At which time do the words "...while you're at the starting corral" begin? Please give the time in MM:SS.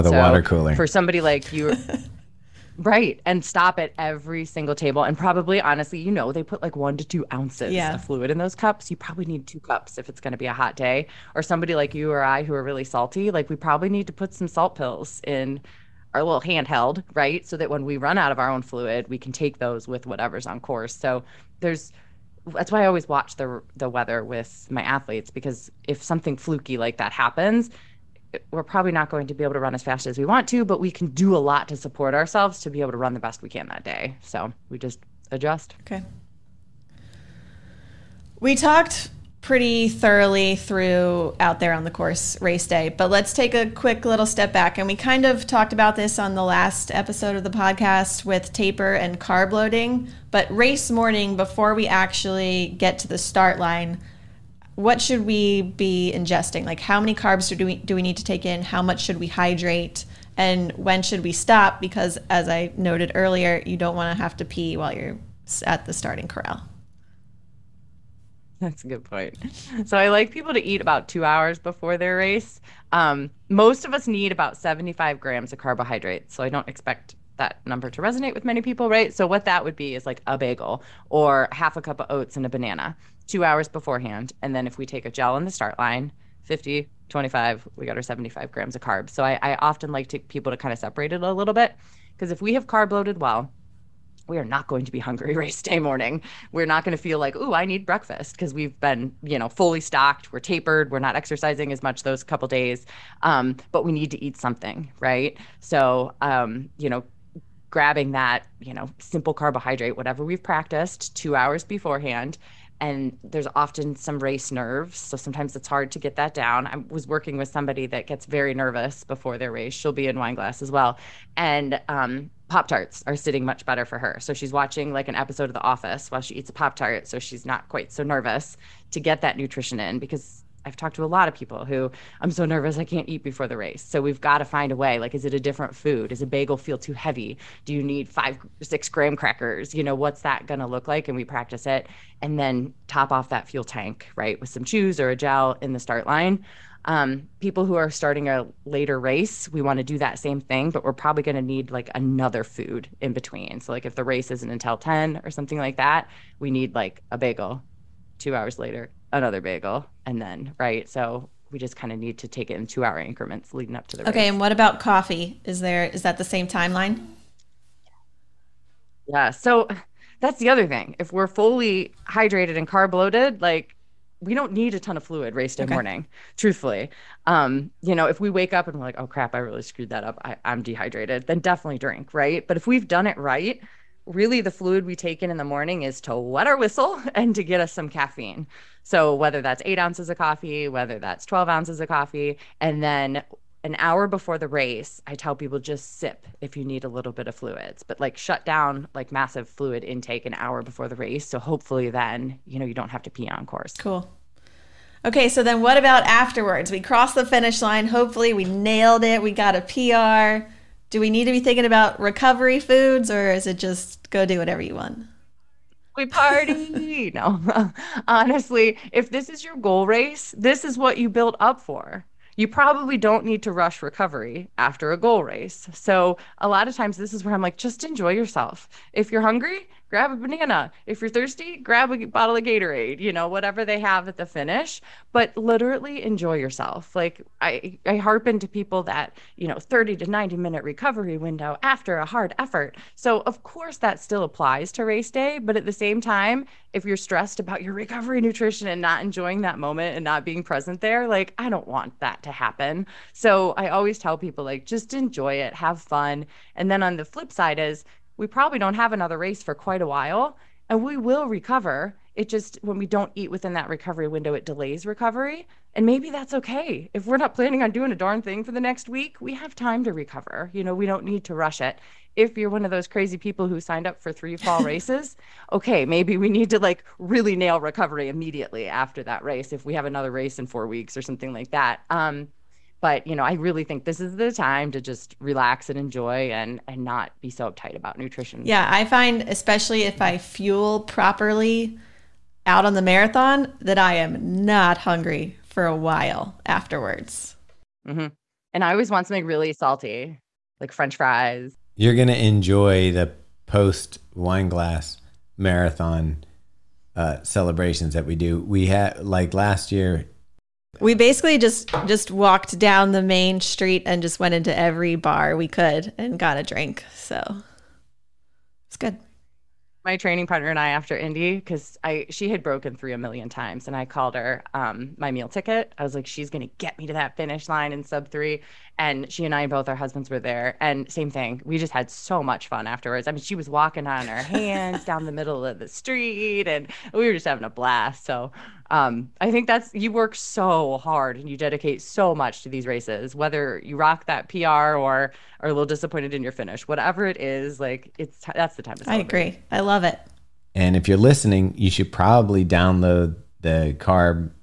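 01:04.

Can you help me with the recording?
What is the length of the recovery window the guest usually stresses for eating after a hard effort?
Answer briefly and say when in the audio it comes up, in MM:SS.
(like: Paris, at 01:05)
30 to 90 minutes, at 03:59.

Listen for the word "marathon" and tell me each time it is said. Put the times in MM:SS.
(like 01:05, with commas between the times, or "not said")
04:52, 05:05.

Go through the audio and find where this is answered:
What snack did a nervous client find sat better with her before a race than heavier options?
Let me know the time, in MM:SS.
02:02.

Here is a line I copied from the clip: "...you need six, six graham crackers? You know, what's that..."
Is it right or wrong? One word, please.
wrong.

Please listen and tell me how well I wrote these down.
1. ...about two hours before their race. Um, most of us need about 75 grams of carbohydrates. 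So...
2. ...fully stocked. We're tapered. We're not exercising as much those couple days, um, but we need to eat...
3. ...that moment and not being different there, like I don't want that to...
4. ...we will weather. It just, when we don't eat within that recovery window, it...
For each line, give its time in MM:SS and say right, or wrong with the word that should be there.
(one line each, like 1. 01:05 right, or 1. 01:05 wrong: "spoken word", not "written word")
1. 01:10 right
2. 01:39 right
3. 04:09 wrong: "present", not "different"
4. 04:20 wrong: "recover", not "weather".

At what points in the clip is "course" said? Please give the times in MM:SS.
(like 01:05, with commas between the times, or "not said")
00:20, 00:41, 03:23, 04:03.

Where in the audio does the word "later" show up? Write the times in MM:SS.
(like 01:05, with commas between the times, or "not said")
02:28, 02:38.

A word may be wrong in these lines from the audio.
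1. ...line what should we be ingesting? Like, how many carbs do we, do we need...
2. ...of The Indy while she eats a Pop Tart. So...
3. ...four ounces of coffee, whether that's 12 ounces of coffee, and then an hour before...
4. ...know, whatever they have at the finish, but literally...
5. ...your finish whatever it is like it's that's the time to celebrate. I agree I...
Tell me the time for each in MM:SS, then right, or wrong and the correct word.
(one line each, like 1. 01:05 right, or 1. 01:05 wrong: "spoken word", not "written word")
1. 00:53 right
2. 02:05 wrong: "Office", not "Indy"
3. 03:09 wrong: "eight", not "four"
4. 03:53 right
5. 05:46 right.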